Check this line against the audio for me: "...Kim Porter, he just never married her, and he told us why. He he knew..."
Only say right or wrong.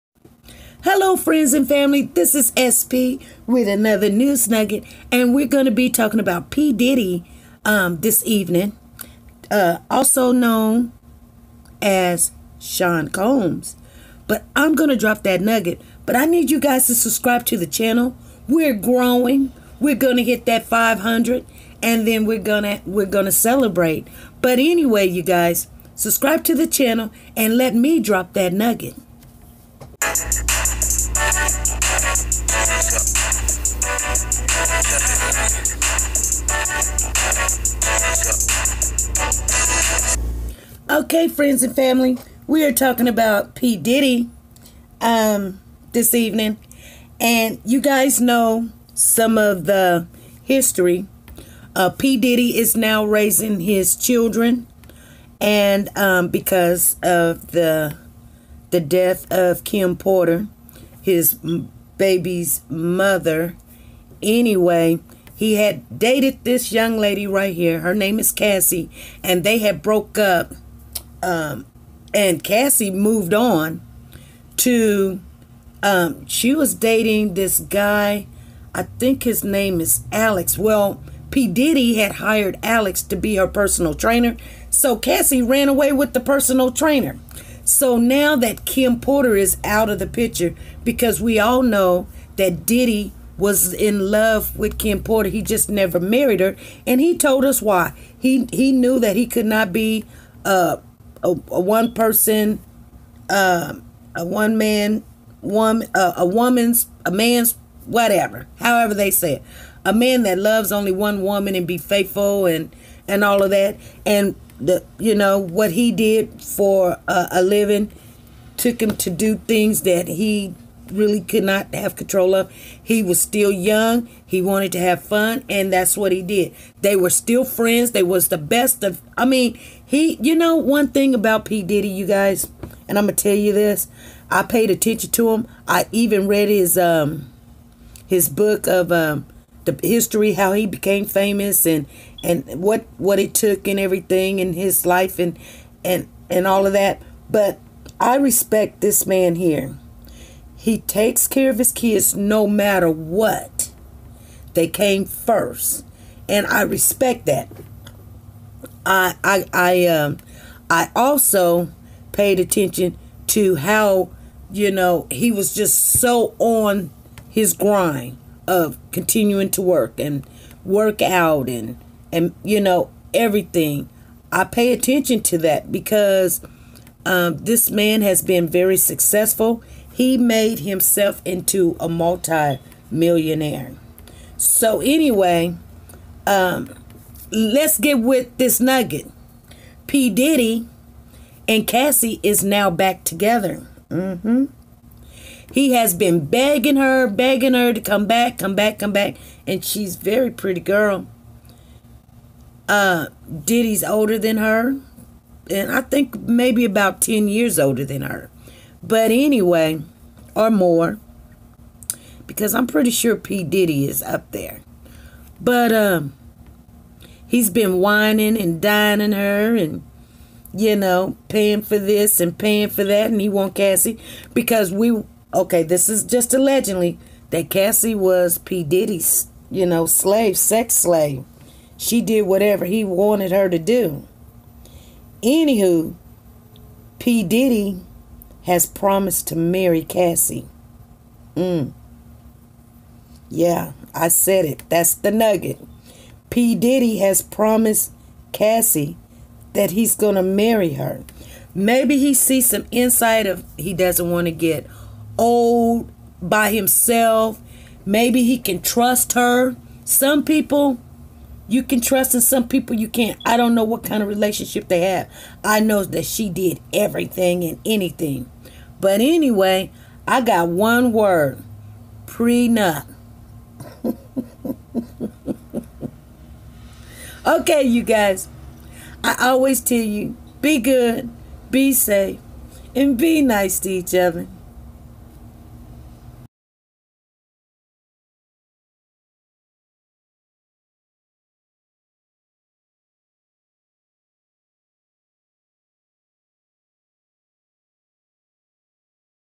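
right.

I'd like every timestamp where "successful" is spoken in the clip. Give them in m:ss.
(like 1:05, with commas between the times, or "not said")
2:58.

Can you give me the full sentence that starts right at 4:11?
Maybe he sees some insight of he doesn't want to get old by himself.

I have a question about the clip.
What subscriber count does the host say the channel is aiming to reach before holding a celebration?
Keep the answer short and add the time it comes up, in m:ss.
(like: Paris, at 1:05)
500, at 0:20.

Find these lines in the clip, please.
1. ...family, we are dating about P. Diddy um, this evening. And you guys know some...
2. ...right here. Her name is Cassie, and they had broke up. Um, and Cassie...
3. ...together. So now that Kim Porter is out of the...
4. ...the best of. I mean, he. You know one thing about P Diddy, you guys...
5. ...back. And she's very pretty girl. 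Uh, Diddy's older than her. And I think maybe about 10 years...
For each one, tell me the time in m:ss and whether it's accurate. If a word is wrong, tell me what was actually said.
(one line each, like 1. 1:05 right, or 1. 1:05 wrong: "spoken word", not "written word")
1. 0:41 wrong: "talking", not "dating"
2. 1:07 right
3. 1:26 wrong: "trainer", not "together"
4. 2:08 right
5. 3:18 right.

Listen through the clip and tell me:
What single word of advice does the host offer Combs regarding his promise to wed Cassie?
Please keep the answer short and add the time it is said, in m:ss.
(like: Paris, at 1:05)
Prenup, at 4:32.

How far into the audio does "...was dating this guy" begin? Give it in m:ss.
1:16.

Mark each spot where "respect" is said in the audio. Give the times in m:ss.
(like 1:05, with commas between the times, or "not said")
2:28, 2:36.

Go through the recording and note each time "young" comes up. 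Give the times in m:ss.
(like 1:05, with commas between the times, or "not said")
1:06, 2:03.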